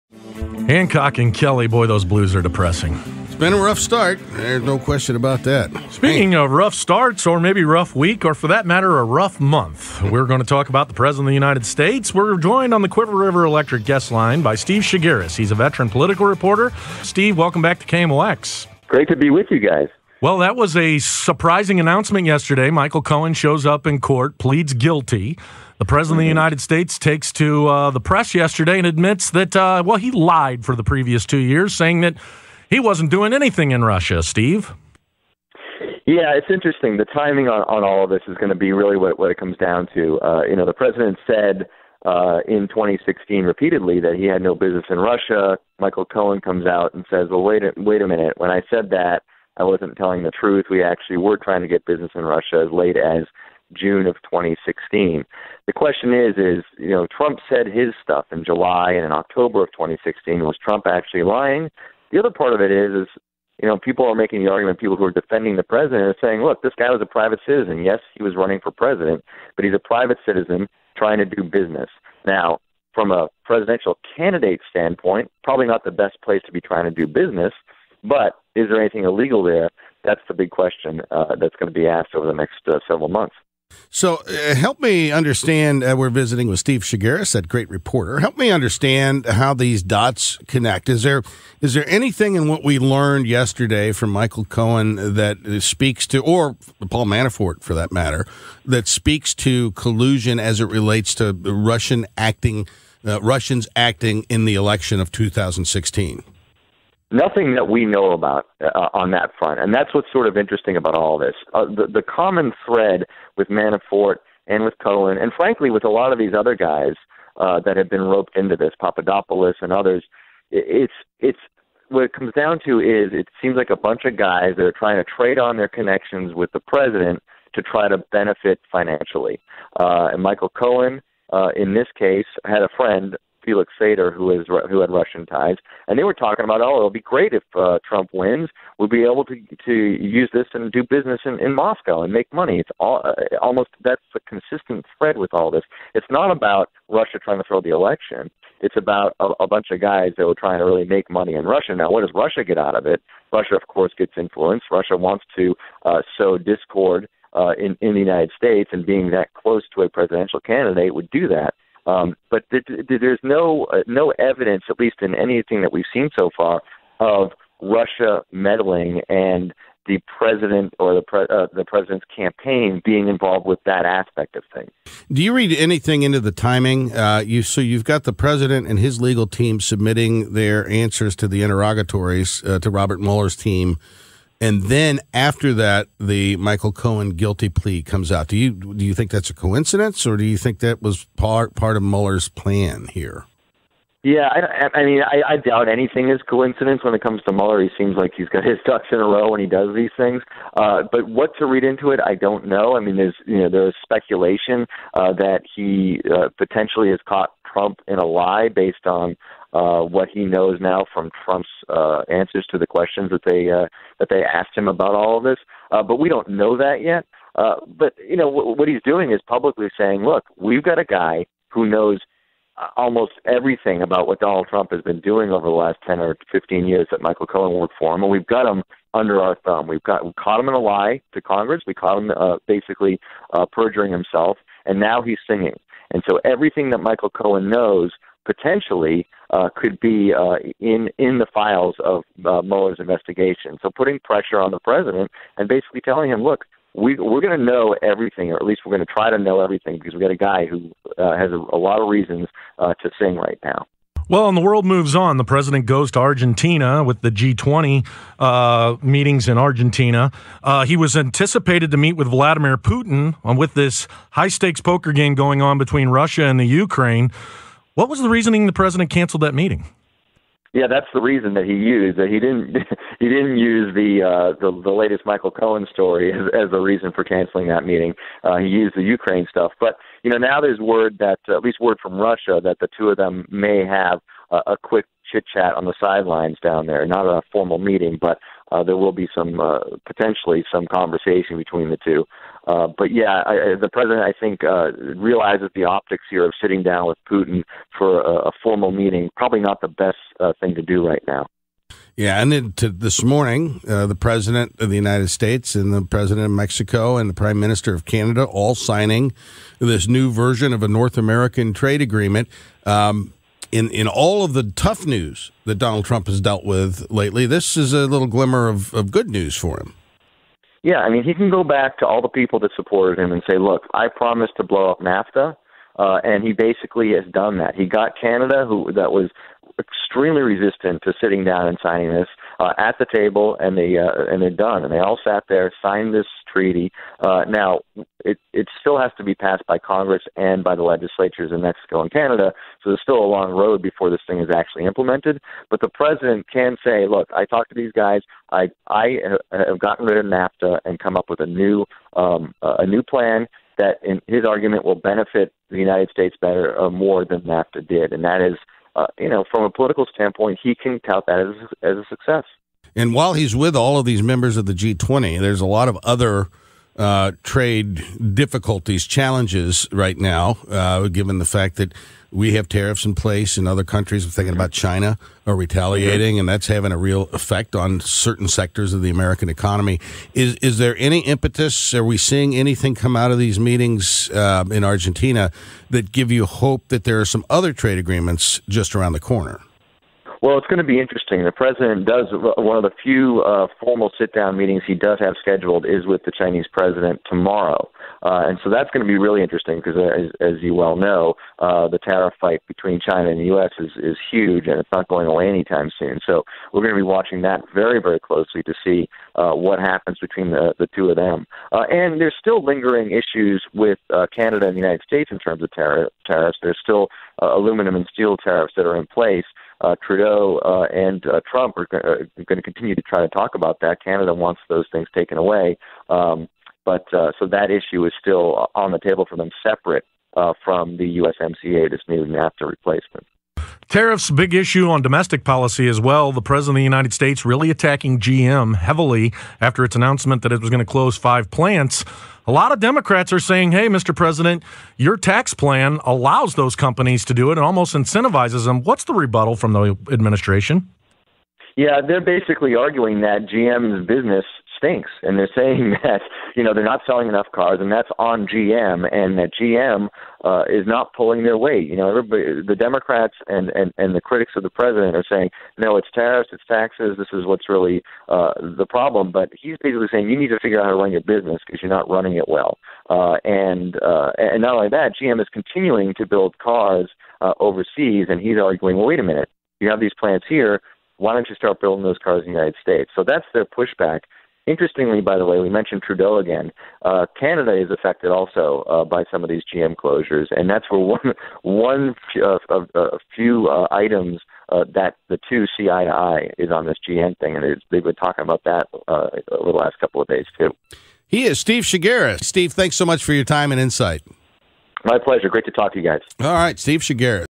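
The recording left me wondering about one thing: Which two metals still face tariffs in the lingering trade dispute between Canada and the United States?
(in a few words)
Aluminum and steel.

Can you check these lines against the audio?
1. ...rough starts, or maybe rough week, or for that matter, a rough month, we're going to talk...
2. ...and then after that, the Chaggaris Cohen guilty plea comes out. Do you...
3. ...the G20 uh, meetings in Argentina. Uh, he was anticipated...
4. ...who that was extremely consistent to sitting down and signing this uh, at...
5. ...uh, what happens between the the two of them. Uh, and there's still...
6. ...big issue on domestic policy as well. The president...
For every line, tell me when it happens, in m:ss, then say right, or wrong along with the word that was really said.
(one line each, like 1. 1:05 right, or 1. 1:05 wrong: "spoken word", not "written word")
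1. 0:06 right
2. 3:04 wrong: "Michael", not "Chaggaris"
3. 4:17 right
4. 5:28 wrong: "resistant", not "consistent"
5. 6:49 right
6. 7:14 right.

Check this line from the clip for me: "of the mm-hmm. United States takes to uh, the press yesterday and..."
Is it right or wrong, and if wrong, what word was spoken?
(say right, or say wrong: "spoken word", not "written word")
right.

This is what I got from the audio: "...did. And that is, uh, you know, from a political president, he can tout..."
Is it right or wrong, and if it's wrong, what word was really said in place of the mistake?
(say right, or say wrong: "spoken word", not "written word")
wrong: "standpoint", not "president".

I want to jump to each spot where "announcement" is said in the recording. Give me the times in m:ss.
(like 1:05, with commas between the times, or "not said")
0:21, 7:19.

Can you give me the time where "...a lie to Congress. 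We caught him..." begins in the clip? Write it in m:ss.
3:50.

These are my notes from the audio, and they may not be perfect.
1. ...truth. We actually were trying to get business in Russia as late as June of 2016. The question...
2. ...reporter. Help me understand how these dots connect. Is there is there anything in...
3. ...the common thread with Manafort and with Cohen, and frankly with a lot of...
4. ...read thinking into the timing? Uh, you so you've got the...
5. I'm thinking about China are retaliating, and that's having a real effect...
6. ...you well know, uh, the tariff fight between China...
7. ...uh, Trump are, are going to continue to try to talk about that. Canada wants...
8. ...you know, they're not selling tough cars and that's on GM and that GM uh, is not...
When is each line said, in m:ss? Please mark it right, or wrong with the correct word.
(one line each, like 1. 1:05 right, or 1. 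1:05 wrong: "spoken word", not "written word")
1. 0:50 right
2. 1:27 right
3. 1:51 right
4. 2:55 wrong: "anything", not "thinking"
5. 6:14 right
6. 6:40 right
7. 7:01 right
8. 7:36 wrong: "enough", not "tough".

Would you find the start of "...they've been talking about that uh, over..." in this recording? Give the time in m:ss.
8:17.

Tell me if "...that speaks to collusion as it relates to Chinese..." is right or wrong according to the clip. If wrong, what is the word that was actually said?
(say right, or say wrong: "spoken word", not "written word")
wrong: "Russian", not "Chinese".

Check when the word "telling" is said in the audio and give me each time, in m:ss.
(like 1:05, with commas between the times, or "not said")
0:49, 4:05.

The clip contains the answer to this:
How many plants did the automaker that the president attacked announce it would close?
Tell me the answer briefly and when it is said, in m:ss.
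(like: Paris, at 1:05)
5, at 7:20.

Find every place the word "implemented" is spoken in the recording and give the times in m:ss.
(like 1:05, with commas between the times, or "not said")
5:44.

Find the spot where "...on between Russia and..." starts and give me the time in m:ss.
4:25.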